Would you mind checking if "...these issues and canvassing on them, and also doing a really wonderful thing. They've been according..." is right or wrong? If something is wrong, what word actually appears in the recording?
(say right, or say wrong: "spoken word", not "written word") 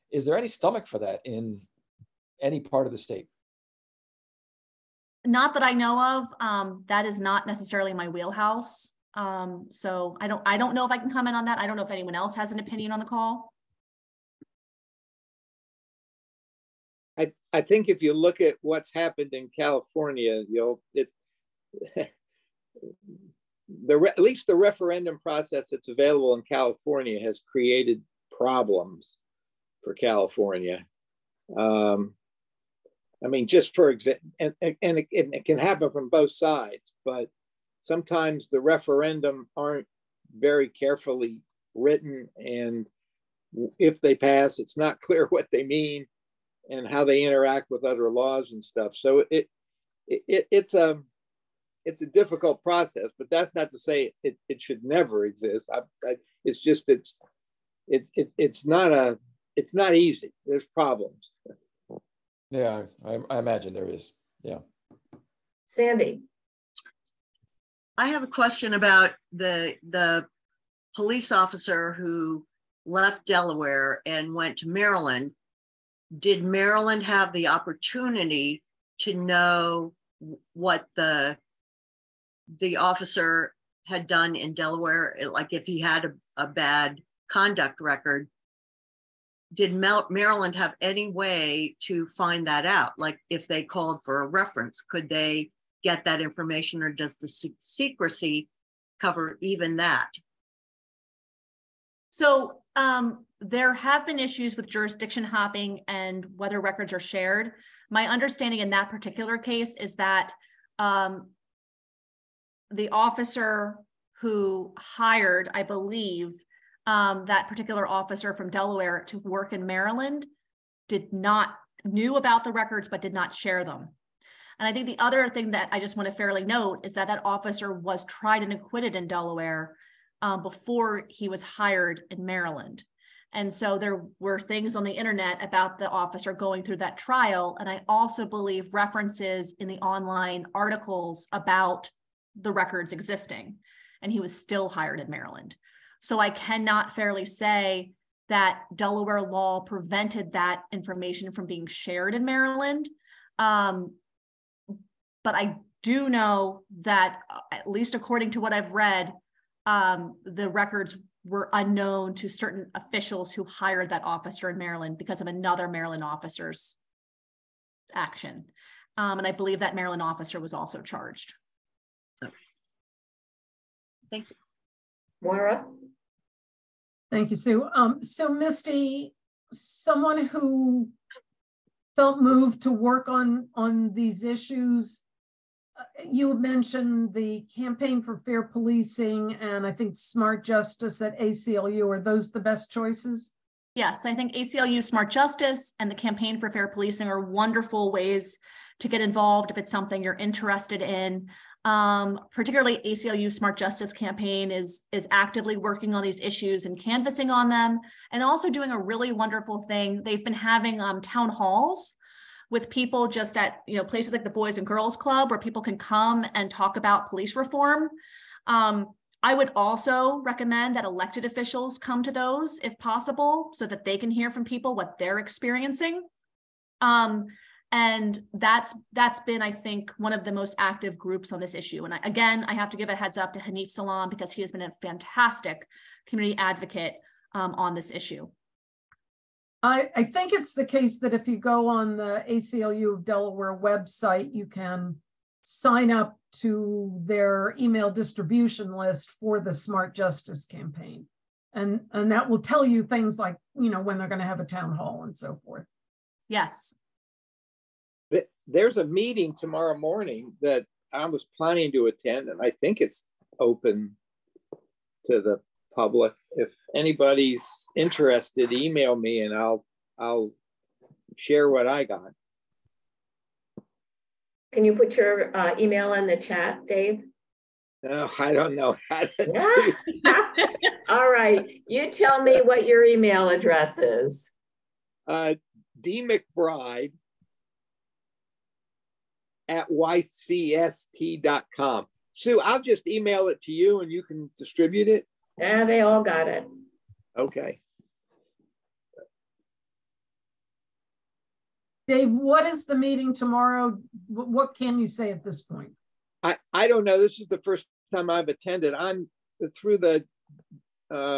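wrong: "having", not "according".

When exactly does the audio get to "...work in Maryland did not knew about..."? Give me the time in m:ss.
1:59.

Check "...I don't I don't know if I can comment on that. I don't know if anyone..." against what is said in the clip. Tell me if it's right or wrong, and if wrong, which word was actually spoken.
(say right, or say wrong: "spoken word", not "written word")
right.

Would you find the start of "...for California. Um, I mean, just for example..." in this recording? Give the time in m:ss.
0:29.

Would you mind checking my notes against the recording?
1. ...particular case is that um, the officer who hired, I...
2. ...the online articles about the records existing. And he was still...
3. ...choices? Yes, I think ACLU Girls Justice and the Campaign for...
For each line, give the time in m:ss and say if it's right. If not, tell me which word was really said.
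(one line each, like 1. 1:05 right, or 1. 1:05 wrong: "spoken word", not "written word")
1. 1:48 right
2. 2:19 right
3. 3:12 wrong: "Smart", not "Girls".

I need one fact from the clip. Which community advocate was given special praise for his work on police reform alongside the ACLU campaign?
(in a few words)
Hanif Salam.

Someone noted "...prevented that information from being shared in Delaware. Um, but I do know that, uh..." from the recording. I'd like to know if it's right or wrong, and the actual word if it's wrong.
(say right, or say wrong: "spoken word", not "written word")
wrong: "Maryland", not "Delaware".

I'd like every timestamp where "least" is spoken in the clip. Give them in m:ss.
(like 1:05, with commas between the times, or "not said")
0:24, 2:37.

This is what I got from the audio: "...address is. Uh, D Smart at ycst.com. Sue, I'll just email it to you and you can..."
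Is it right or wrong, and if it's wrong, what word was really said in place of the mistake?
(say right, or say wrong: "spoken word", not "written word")
wrong: "McBride", not "Smart".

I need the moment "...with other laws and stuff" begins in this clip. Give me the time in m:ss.
0:47.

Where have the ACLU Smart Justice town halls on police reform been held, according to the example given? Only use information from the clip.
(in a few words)
Boys and Girls Club.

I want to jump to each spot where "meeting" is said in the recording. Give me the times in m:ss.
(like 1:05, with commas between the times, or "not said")
4:18, 5:02.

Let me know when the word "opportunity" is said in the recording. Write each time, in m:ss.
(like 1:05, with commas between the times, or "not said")
1:17.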